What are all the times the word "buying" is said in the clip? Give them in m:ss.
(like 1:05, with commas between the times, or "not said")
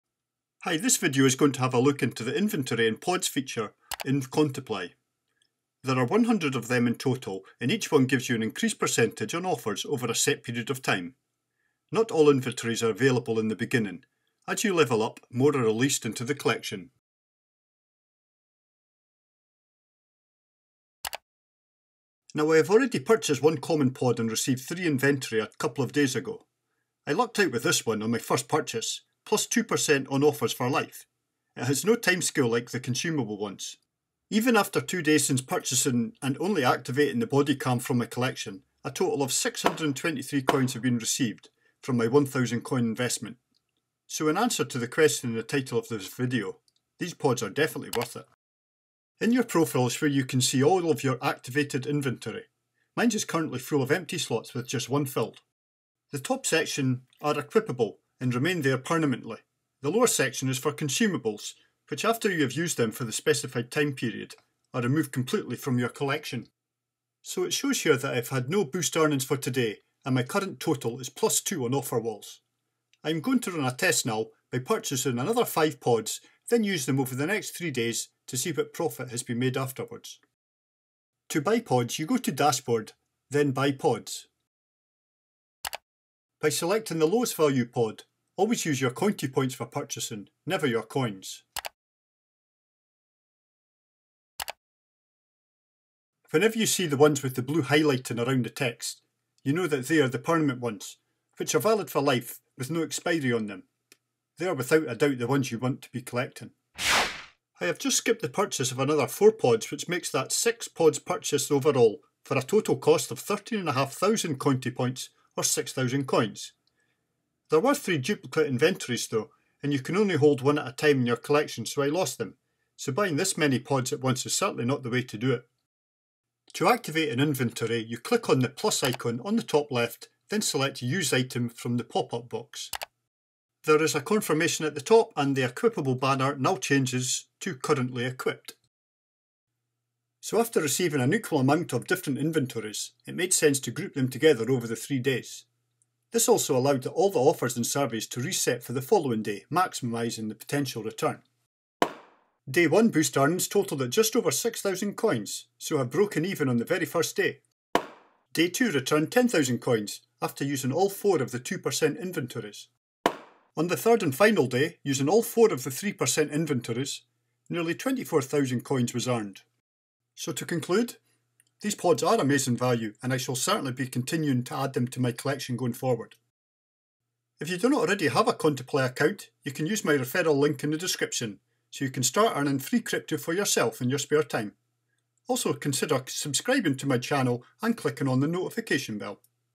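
2:02.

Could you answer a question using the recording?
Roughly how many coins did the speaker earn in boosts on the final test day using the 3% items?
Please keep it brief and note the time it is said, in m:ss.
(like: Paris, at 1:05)
24,000, at 2:47.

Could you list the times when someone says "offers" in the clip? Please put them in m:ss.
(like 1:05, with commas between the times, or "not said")
0:09, 0:30, 1:11, 2:27.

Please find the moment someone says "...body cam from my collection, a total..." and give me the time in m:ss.
0:37.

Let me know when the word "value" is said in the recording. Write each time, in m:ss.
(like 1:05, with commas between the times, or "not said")
1:27, 2:52.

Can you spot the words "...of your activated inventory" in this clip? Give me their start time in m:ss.
0:50.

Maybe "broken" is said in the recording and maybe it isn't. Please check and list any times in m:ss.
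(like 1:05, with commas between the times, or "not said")
2:35.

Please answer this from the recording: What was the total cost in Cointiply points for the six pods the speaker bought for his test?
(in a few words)
13,500.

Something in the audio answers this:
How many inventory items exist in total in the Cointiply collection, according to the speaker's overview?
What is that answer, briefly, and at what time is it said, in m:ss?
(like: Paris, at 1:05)
100, at 0:06.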